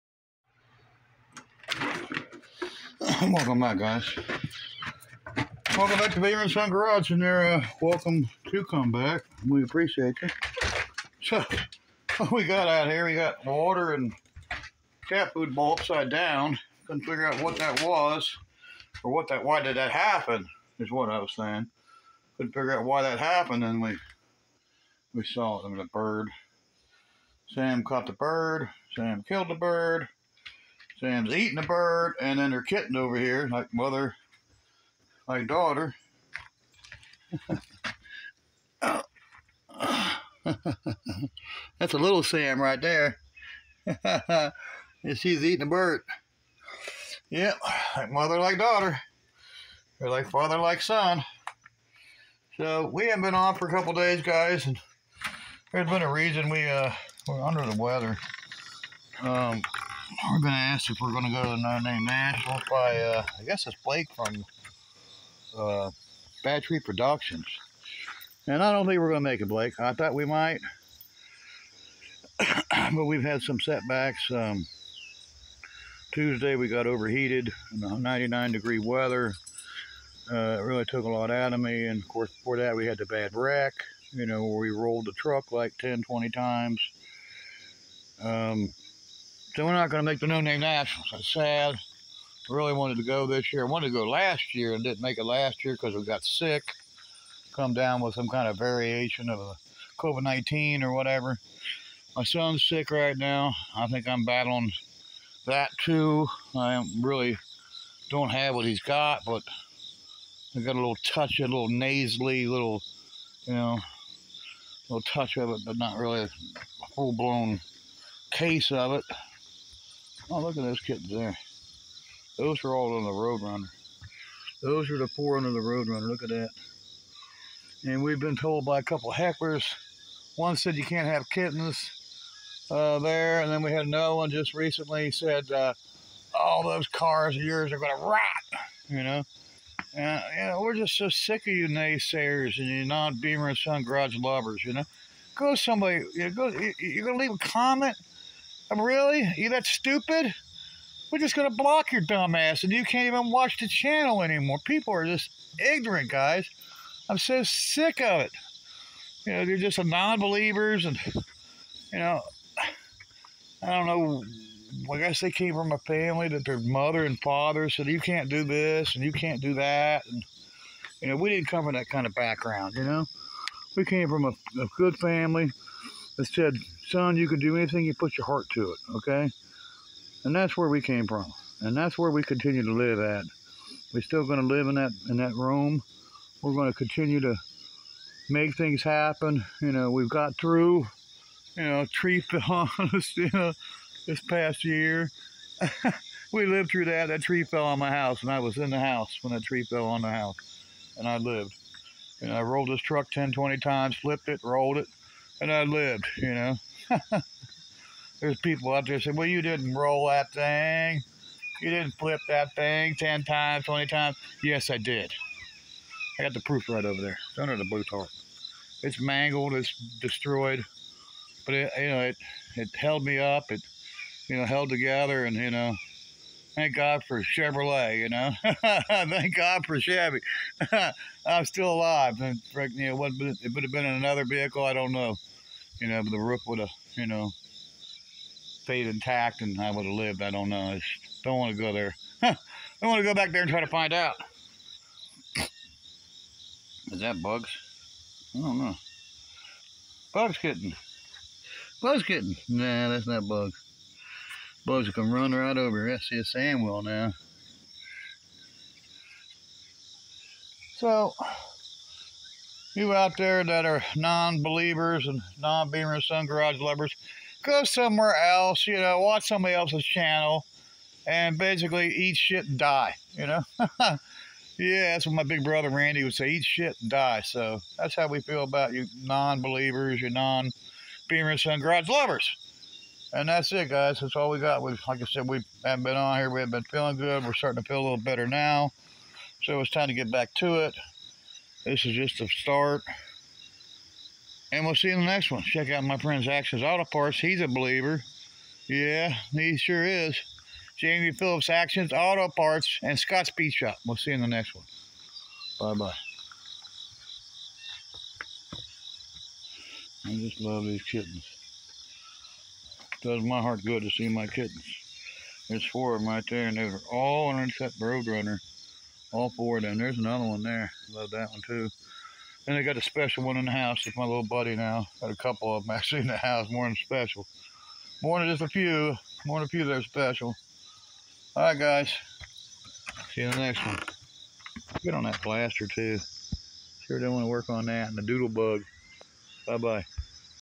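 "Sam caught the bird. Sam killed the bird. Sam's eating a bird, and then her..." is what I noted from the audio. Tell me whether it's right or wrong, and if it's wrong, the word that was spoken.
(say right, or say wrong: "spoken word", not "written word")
right.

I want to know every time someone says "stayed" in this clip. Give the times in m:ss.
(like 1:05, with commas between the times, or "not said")
3:58.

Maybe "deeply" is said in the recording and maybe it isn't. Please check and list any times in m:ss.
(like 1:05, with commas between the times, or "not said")
not said.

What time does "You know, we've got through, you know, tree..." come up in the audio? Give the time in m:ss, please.
3:09.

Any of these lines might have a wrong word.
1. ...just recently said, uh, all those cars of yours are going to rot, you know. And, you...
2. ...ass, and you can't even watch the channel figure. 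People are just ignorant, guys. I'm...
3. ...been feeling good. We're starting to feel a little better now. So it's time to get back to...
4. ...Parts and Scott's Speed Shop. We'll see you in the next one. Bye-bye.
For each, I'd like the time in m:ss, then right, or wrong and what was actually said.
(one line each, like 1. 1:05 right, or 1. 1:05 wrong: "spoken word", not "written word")
1. 2:14 right
2. 2:32 wrong: "anymore", not "figure"
3. 4:46 right
4. 5:02 right.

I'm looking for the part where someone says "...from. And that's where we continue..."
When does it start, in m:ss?
3:01.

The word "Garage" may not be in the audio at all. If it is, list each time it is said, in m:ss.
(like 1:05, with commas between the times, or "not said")
0:06, 2:23, 4:26, 4:41.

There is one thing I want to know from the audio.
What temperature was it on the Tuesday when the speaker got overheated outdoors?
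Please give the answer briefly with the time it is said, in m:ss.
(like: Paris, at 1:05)
99 degrees, at 1:18.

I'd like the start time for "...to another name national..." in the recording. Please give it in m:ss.
1:01.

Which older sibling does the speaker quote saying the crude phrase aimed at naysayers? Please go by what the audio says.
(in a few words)
Randy.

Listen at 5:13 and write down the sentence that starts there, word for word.
It does my heart good to see my kittens.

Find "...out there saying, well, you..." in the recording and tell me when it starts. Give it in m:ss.
3:28.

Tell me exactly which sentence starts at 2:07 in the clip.
And we've been told by a couple hecklers.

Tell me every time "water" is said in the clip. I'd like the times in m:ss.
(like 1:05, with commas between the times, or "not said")
0:13.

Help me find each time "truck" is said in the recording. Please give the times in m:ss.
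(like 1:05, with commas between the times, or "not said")
1:25, 3:22.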